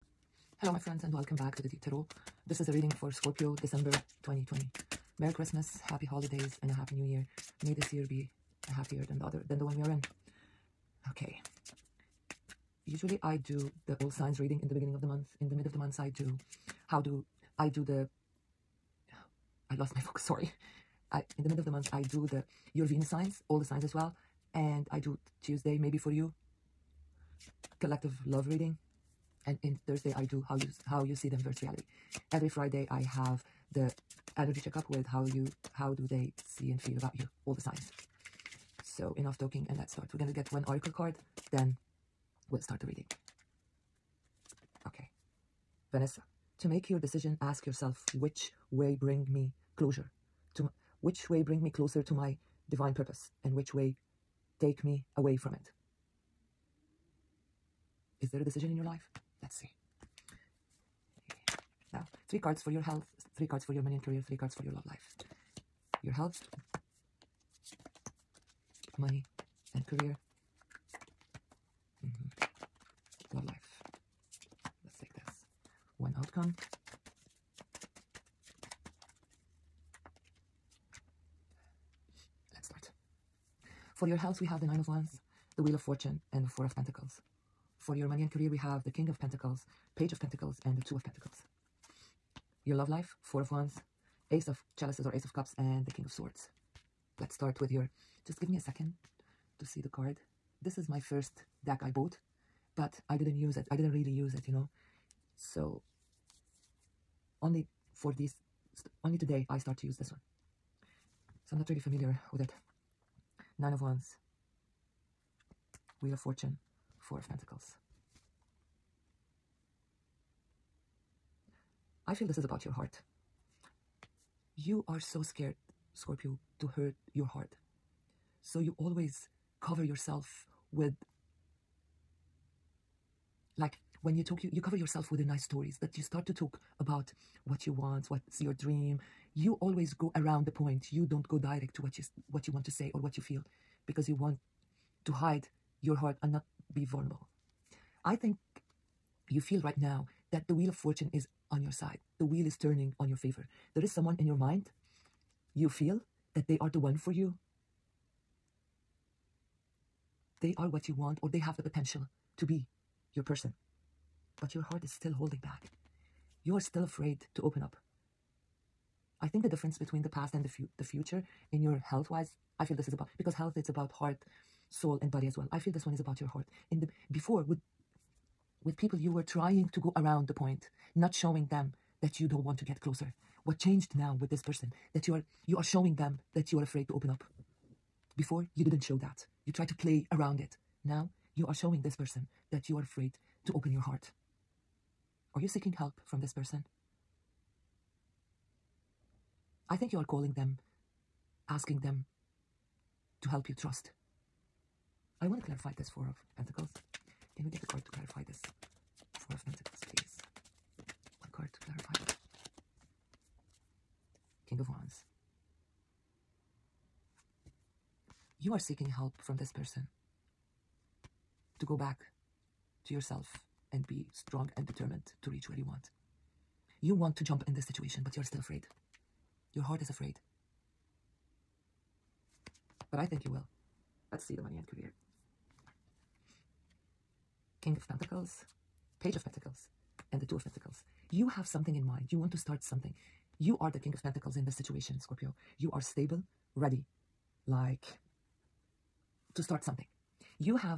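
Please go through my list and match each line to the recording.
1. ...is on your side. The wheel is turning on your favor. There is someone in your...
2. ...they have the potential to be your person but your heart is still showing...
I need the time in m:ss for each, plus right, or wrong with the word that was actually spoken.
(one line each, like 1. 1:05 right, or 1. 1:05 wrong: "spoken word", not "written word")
1. 2:31 right
2. 2:41 wrong: "holding", not "showing".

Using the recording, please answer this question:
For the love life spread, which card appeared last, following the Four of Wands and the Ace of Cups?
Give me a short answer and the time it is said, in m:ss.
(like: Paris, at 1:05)
King of Swords, at 1:35.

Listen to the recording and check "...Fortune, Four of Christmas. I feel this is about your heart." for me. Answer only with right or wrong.
wrong.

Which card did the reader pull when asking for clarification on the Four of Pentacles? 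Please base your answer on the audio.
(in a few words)
King of Wands.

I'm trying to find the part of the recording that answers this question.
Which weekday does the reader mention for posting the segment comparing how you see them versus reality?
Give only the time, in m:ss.
0:29.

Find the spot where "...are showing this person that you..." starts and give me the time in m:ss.
3:11.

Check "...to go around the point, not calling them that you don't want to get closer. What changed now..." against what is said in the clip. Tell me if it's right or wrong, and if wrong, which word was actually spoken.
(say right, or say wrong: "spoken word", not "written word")
wrong: "showing", not "calling".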